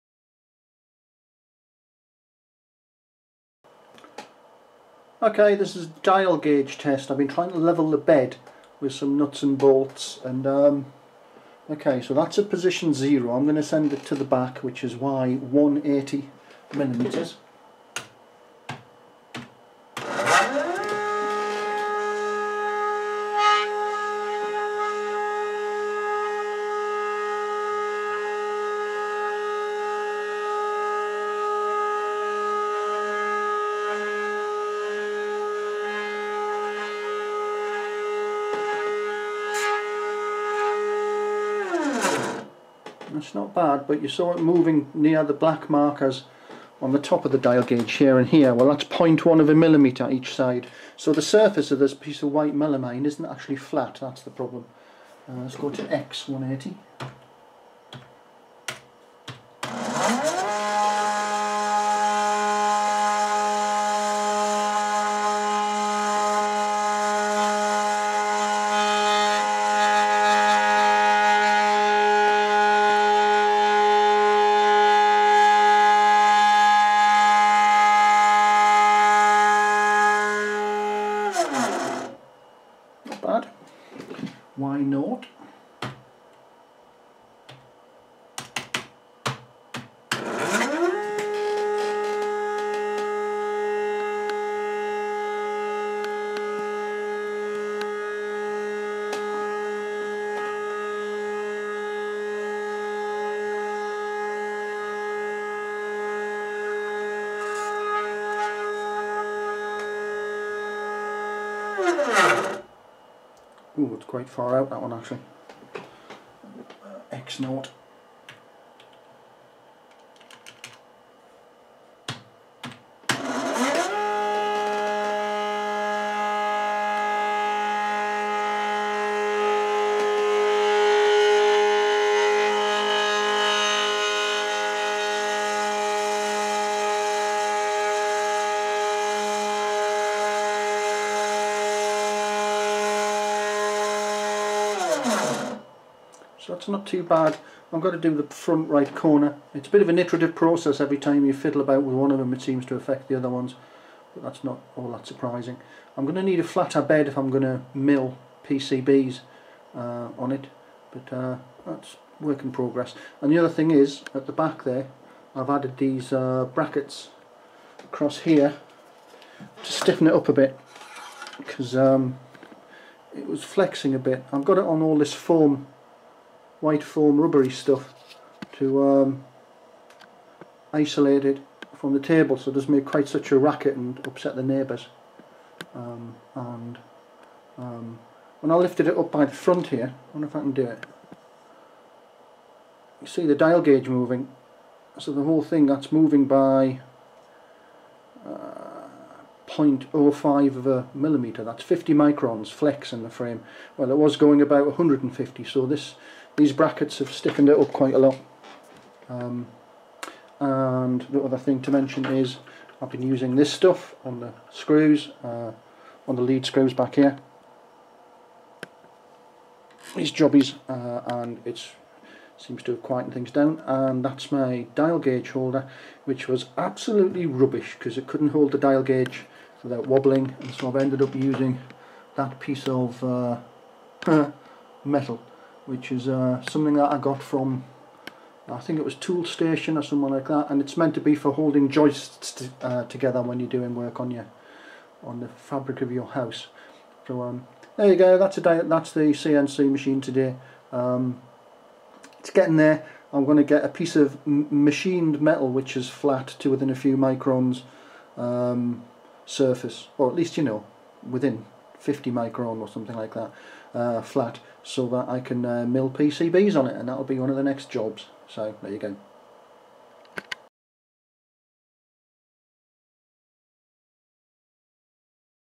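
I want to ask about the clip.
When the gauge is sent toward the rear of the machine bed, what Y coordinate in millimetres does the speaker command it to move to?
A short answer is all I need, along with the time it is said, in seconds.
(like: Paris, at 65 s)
180, at 14 s.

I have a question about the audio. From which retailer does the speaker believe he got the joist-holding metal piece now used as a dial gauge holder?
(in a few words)
Toolstation.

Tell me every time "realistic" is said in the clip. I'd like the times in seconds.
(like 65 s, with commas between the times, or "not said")
not said.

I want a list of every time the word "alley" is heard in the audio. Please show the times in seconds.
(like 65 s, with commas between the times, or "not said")
not said.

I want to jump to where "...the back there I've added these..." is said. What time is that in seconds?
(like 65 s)
164 s.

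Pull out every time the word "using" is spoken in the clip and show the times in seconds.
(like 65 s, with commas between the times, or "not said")
213 s, 231 s.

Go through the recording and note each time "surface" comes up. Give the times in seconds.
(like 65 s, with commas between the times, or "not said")
51 s, 259 s.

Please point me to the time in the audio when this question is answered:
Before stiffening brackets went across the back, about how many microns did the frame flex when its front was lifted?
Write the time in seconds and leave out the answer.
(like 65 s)
204 s.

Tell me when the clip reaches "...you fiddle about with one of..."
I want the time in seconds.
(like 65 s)
151 s.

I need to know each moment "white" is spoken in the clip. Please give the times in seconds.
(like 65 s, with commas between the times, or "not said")
52 s, 176 s.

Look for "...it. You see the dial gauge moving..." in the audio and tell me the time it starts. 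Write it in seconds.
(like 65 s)
190 s.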